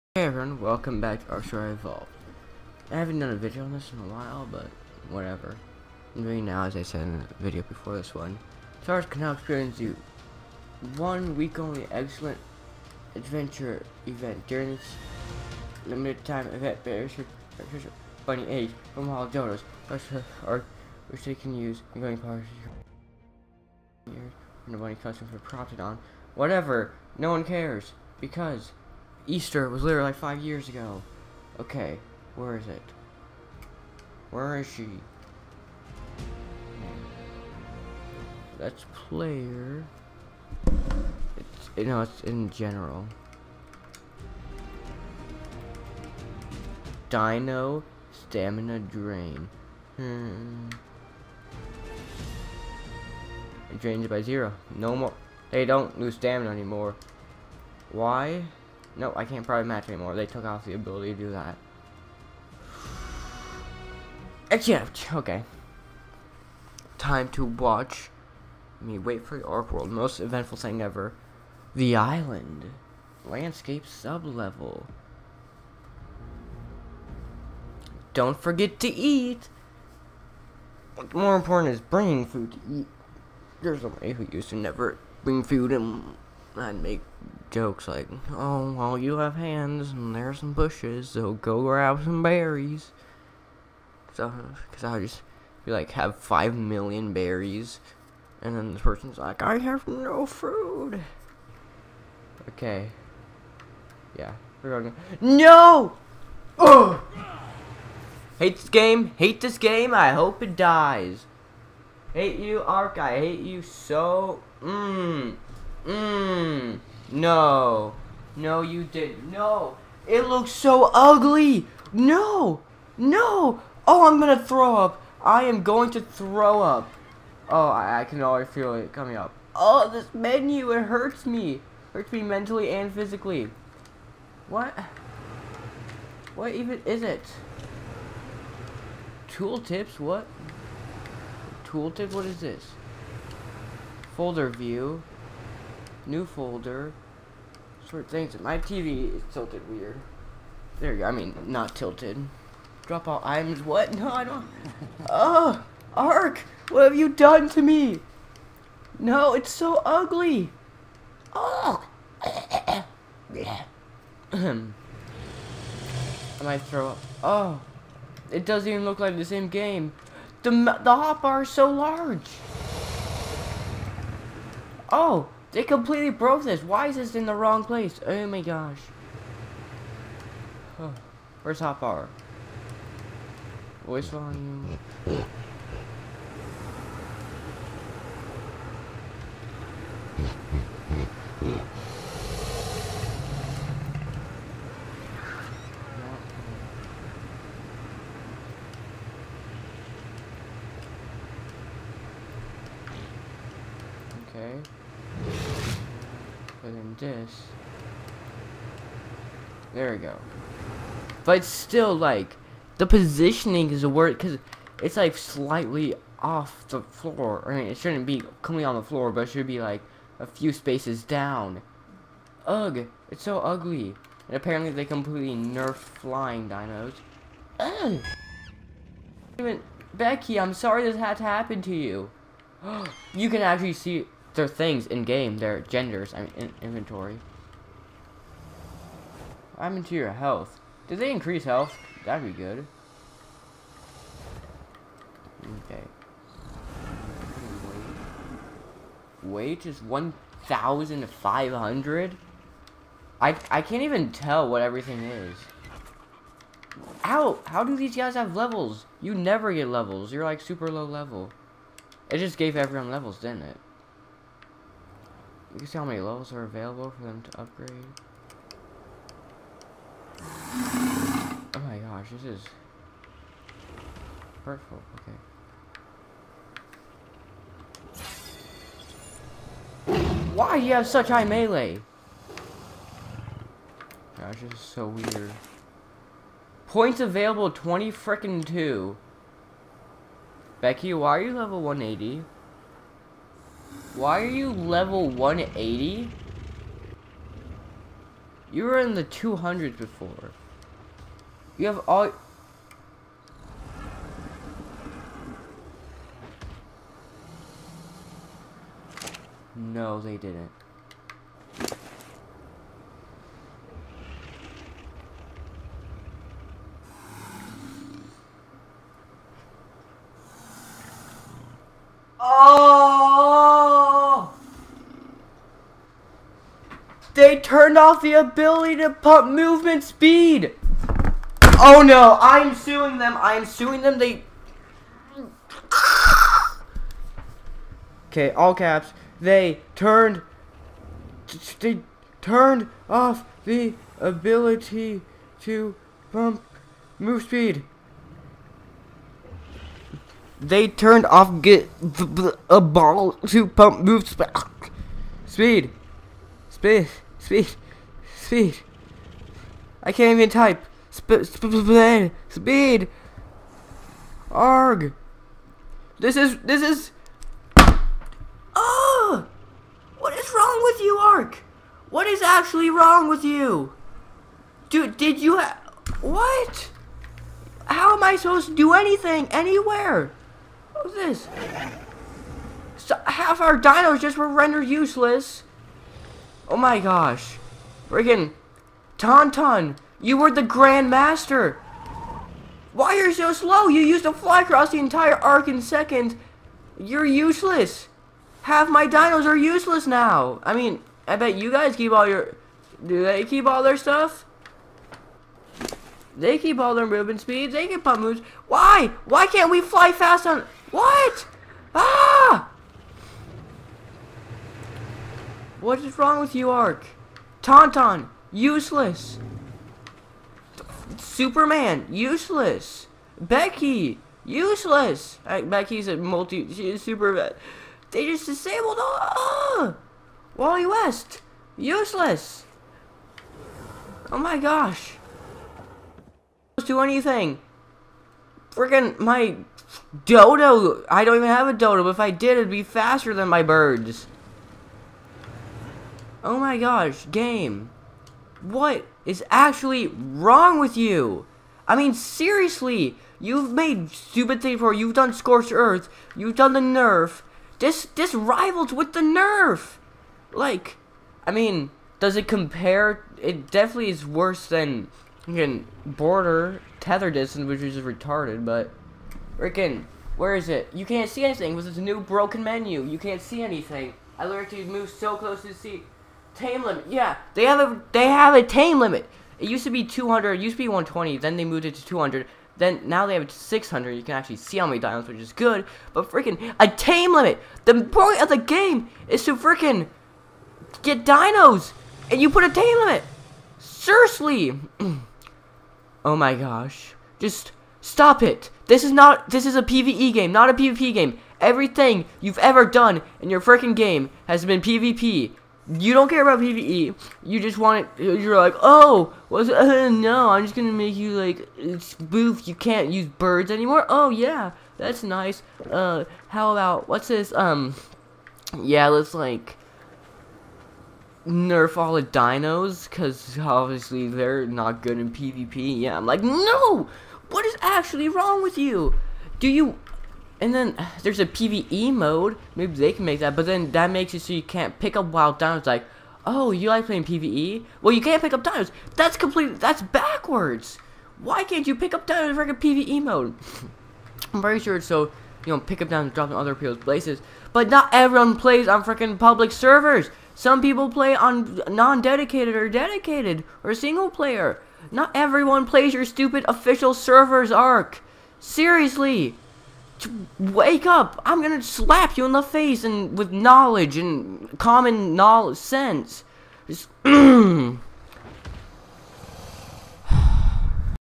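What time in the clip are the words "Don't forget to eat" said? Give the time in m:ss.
1:18.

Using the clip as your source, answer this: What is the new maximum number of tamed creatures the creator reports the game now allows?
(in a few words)
600.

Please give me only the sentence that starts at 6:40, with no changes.
I mean, I bet you guys keep all your...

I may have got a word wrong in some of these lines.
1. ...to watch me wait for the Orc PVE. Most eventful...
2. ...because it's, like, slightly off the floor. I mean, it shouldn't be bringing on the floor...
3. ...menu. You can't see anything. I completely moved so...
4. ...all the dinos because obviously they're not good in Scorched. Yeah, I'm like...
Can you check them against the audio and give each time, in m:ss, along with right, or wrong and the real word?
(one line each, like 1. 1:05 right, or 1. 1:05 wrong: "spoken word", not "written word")
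1. 1:07 wrong: "World", not "PVE"
2. 3:34 wrong: "coming", not "bringing"
3. 7:52 wrong: "literally", not "completely"
4. 8:41 wrong: "PvP", not "Scorched".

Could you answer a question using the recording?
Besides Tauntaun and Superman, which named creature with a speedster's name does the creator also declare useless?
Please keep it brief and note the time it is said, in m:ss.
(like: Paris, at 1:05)
Wally West, at 7:10.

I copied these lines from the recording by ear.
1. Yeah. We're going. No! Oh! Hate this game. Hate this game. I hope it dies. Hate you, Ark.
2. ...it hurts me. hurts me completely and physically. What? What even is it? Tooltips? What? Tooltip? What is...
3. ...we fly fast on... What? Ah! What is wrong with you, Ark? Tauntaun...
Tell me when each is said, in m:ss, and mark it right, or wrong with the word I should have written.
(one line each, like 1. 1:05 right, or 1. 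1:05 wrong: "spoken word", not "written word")
1. 1:44 right
2. 2:10 wrong: "mentally", not "completely"
3. 6:49 right.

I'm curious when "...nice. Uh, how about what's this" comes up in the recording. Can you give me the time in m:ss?
8:35.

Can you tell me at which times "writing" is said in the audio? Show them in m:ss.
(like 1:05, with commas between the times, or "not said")
not said.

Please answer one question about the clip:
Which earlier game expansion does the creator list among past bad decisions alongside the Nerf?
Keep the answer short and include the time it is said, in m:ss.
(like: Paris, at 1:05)
Scorched Earth, at 7:35.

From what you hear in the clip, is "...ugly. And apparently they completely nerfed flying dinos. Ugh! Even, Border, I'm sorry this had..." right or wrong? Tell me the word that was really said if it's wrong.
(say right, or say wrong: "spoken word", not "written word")
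wrong: "Becky", not "Border".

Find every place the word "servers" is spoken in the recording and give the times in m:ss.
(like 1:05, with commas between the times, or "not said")
9:09, 9:16.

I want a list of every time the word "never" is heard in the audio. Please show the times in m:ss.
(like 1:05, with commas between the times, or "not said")
1:24, 4:19.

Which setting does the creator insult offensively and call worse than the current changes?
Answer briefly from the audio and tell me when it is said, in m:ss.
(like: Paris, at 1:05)
Border Tether Distance, at 7:45.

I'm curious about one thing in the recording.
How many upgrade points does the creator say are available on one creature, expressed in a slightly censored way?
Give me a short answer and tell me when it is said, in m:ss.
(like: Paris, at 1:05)
22, at 4:47.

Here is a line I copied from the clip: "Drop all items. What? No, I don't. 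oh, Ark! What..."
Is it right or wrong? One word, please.
right.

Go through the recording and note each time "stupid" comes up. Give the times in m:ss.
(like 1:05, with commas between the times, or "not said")
7:33, 9:16.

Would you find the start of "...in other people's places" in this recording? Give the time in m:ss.
9:06.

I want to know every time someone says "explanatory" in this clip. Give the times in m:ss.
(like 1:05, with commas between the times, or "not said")
not said.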